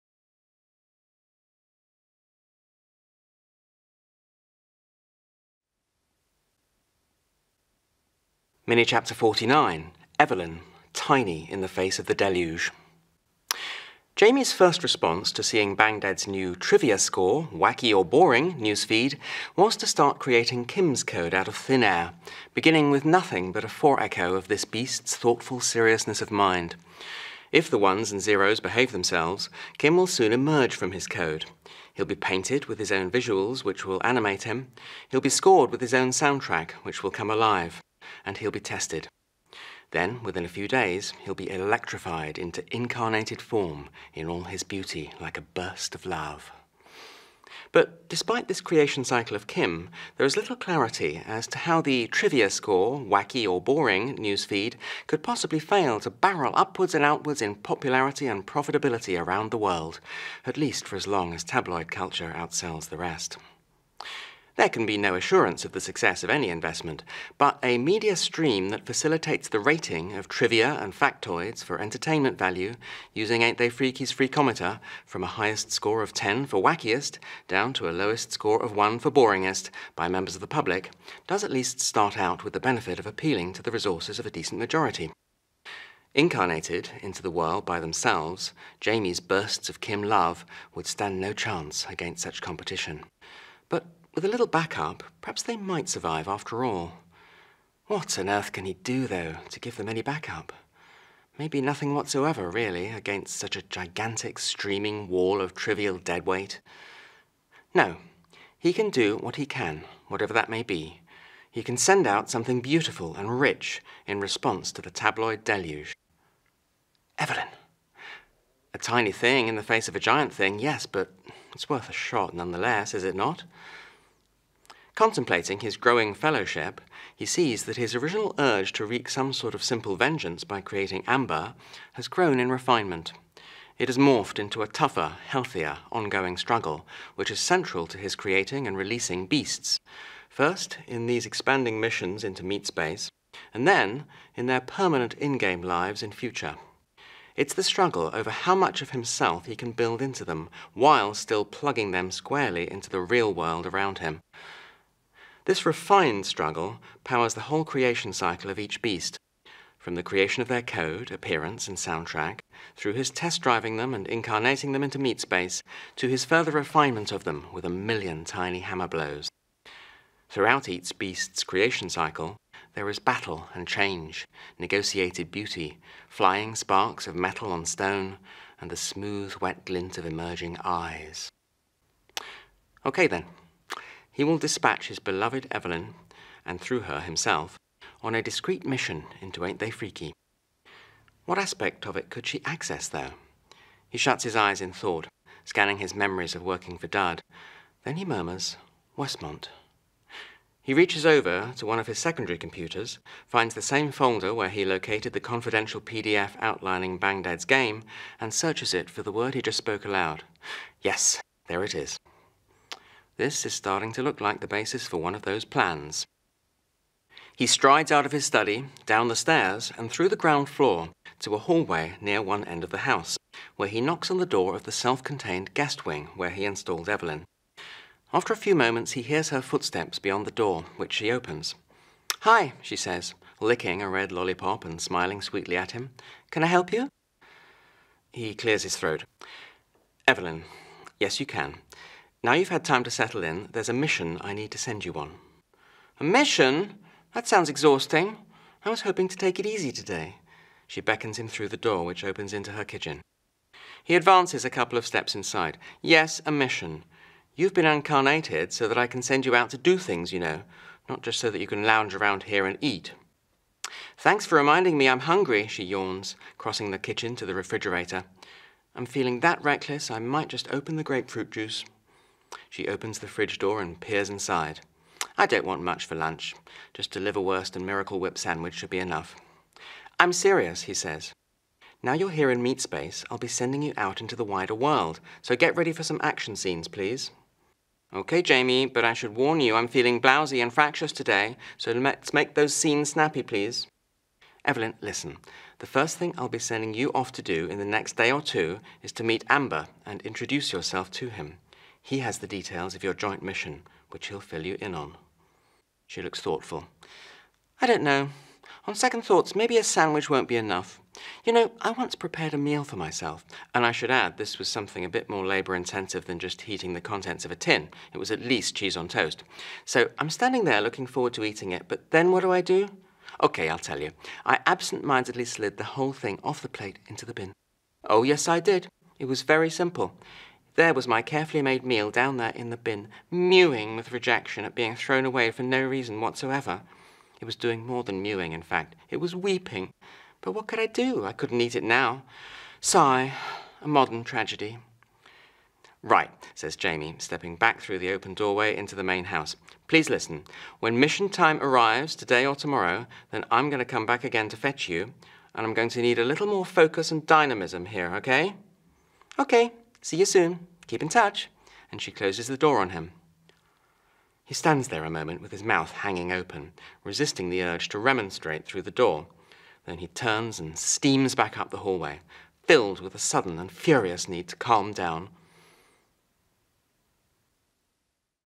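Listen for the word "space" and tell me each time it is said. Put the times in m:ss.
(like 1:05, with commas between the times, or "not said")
2:22, 2:45, 4:42.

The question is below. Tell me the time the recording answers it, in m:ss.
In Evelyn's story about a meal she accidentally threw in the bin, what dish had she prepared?
5:18.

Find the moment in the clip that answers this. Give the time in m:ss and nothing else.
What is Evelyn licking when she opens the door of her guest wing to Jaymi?
3:53.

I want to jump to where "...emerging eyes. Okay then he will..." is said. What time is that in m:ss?
3:00.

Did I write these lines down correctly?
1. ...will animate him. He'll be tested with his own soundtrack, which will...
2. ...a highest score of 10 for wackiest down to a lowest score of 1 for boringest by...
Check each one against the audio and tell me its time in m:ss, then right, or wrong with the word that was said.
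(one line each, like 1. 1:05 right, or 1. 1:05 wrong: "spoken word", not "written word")
1. 0:33 wrong: "scored", not "tested"
2. 1:15 right.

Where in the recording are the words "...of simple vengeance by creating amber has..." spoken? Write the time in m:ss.
2:09.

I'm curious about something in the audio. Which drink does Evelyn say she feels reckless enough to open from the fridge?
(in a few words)
grapefruit juice.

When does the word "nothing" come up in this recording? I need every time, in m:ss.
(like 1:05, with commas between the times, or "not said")
0:23, 1:41.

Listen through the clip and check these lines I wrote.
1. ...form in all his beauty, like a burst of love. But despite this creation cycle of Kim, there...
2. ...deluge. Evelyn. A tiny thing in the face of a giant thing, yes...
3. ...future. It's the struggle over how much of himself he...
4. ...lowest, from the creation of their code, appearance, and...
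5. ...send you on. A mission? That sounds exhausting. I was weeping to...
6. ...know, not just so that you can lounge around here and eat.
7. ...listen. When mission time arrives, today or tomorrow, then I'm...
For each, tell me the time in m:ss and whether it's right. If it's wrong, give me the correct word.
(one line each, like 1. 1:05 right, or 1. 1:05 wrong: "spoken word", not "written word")
1. 0:43 right
2. 1:55 right
3. 2:26 right
4. 2:38 wrong: "beast", not "lowest"
5. 4:04 wrong: "hoping", not "weeping"
6. 4:20 right
7. 5:49 right.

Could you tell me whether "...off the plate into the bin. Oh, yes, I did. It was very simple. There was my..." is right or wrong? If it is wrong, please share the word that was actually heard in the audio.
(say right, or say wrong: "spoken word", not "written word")
right.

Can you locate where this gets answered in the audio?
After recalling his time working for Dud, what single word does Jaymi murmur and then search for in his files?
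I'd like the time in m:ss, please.
3:18.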